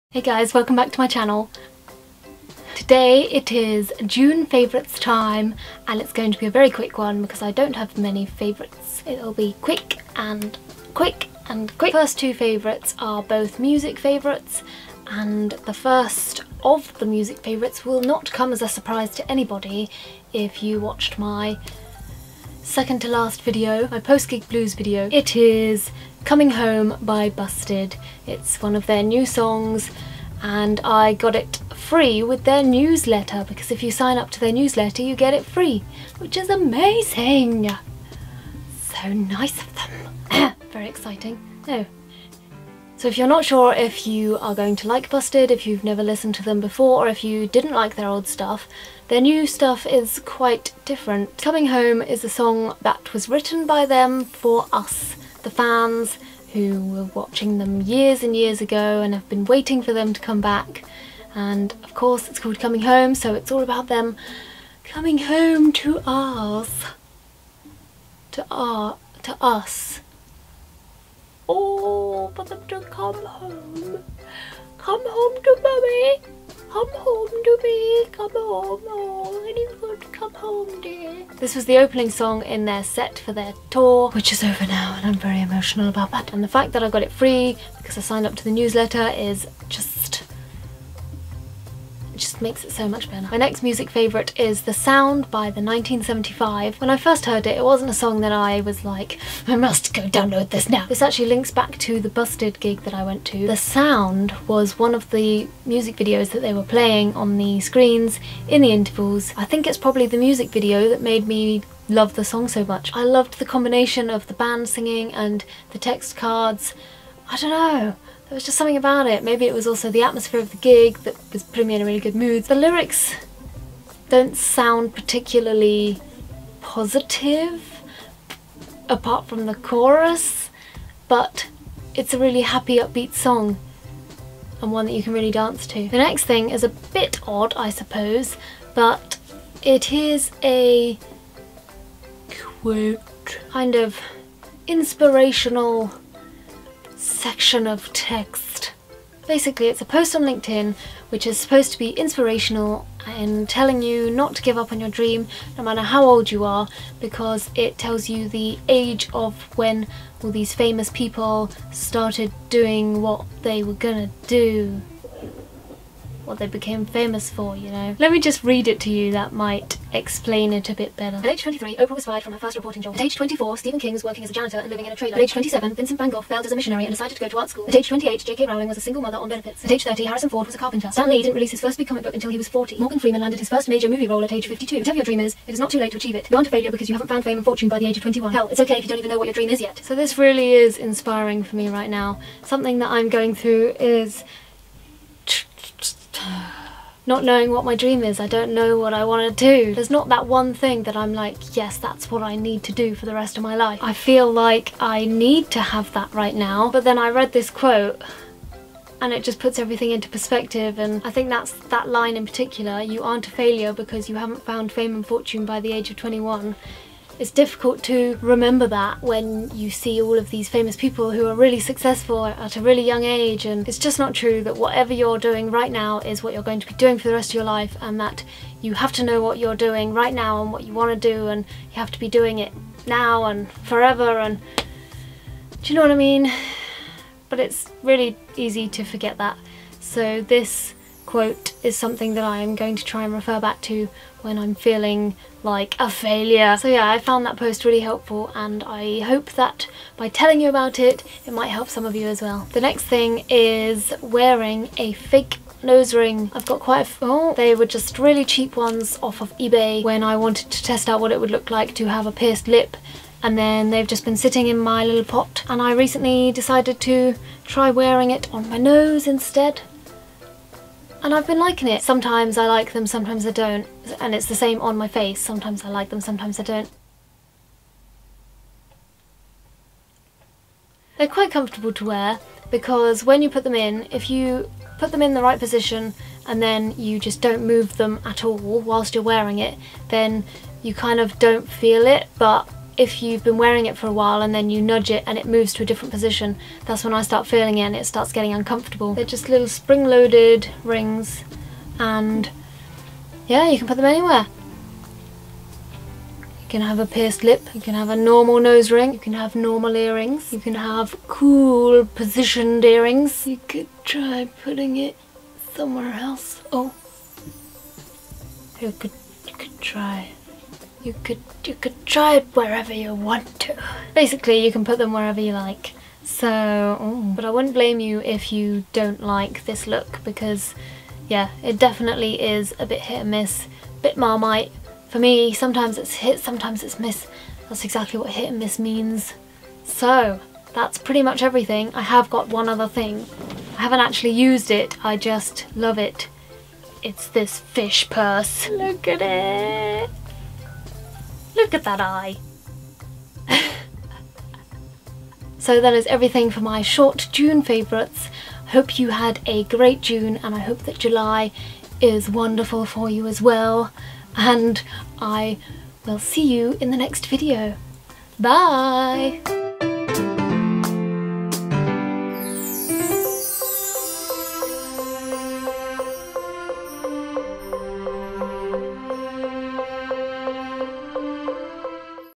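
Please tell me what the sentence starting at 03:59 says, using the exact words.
So this quote is something that I am going to try and refer back to when I'm feeling like a failure.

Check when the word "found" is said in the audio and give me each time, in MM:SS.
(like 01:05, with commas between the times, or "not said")
03:07, 03:34, 04:06.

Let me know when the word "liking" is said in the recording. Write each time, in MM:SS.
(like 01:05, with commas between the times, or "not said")
04:31.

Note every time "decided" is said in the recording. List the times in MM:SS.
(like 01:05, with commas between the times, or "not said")
02:56, 04:26.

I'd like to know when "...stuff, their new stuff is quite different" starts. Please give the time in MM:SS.
00:48.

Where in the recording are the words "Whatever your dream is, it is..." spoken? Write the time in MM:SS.
03:04.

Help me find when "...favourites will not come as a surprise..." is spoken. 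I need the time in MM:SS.
00:17.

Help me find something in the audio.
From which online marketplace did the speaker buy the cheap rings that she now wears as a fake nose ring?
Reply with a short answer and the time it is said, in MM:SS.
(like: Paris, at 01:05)
eBay, at 04:19.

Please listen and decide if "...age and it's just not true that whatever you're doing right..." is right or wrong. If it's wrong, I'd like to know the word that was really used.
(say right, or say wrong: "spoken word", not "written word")
right.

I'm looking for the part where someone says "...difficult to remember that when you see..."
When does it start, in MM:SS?
03:37.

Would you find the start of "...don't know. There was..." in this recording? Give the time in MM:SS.
01:57.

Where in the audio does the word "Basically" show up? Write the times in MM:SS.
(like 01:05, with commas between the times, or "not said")
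02:29, 05:23.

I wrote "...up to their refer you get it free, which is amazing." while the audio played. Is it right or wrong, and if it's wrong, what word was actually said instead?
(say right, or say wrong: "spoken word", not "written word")
wrong: "newsletter", not "refer".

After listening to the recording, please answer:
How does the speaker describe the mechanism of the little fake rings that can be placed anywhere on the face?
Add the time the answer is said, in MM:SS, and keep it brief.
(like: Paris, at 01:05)
spring-loaded, at 04:59.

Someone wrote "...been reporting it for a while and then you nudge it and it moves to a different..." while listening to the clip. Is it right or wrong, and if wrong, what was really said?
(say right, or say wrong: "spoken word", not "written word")
wrong: "wearing", not "reporting".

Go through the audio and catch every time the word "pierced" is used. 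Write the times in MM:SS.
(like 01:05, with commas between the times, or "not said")
04:22, 05:06.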